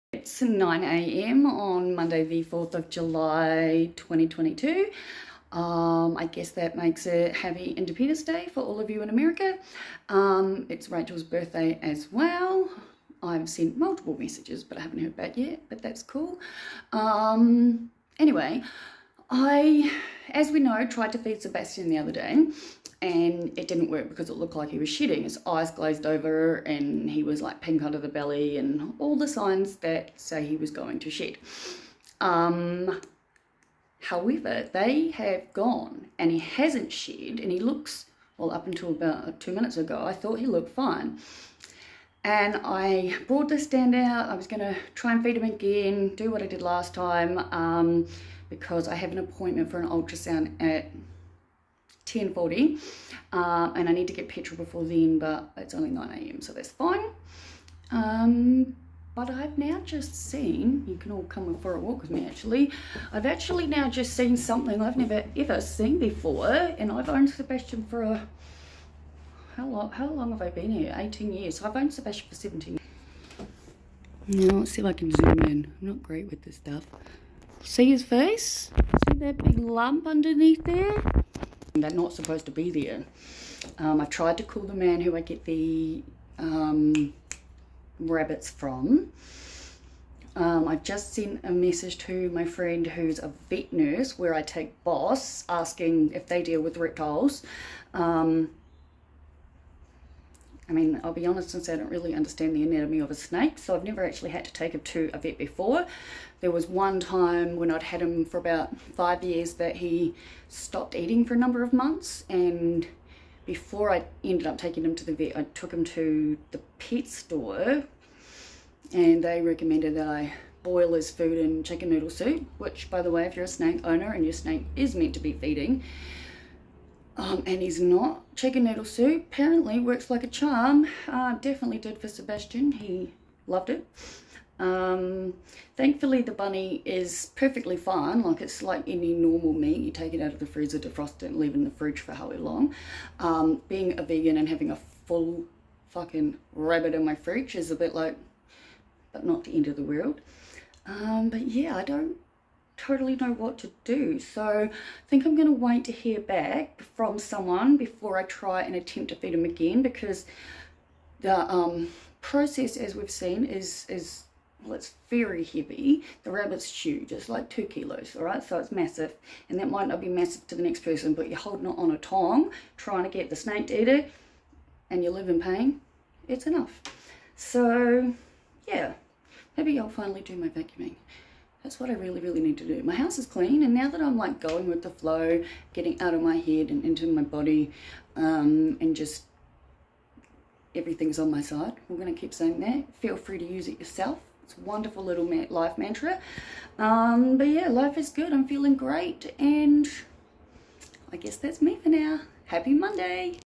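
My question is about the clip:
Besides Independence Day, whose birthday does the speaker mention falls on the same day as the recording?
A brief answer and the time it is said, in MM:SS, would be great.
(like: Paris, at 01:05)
Rachel, at 00:10.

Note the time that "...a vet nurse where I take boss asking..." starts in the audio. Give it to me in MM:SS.
01:33.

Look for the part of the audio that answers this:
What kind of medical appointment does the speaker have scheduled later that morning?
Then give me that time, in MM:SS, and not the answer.
00:49.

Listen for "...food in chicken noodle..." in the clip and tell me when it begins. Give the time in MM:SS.
02:01.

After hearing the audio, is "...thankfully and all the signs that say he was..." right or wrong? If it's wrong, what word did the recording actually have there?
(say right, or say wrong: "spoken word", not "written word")
wrong: "belly", not "thankfully".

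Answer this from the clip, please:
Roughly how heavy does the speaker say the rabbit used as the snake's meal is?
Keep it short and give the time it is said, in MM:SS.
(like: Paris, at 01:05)
2 kilos, at 02:47.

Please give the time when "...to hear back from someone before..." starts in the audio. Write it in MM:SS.
02:35.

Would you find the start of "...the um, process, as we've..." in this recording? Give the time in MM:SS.
02:41.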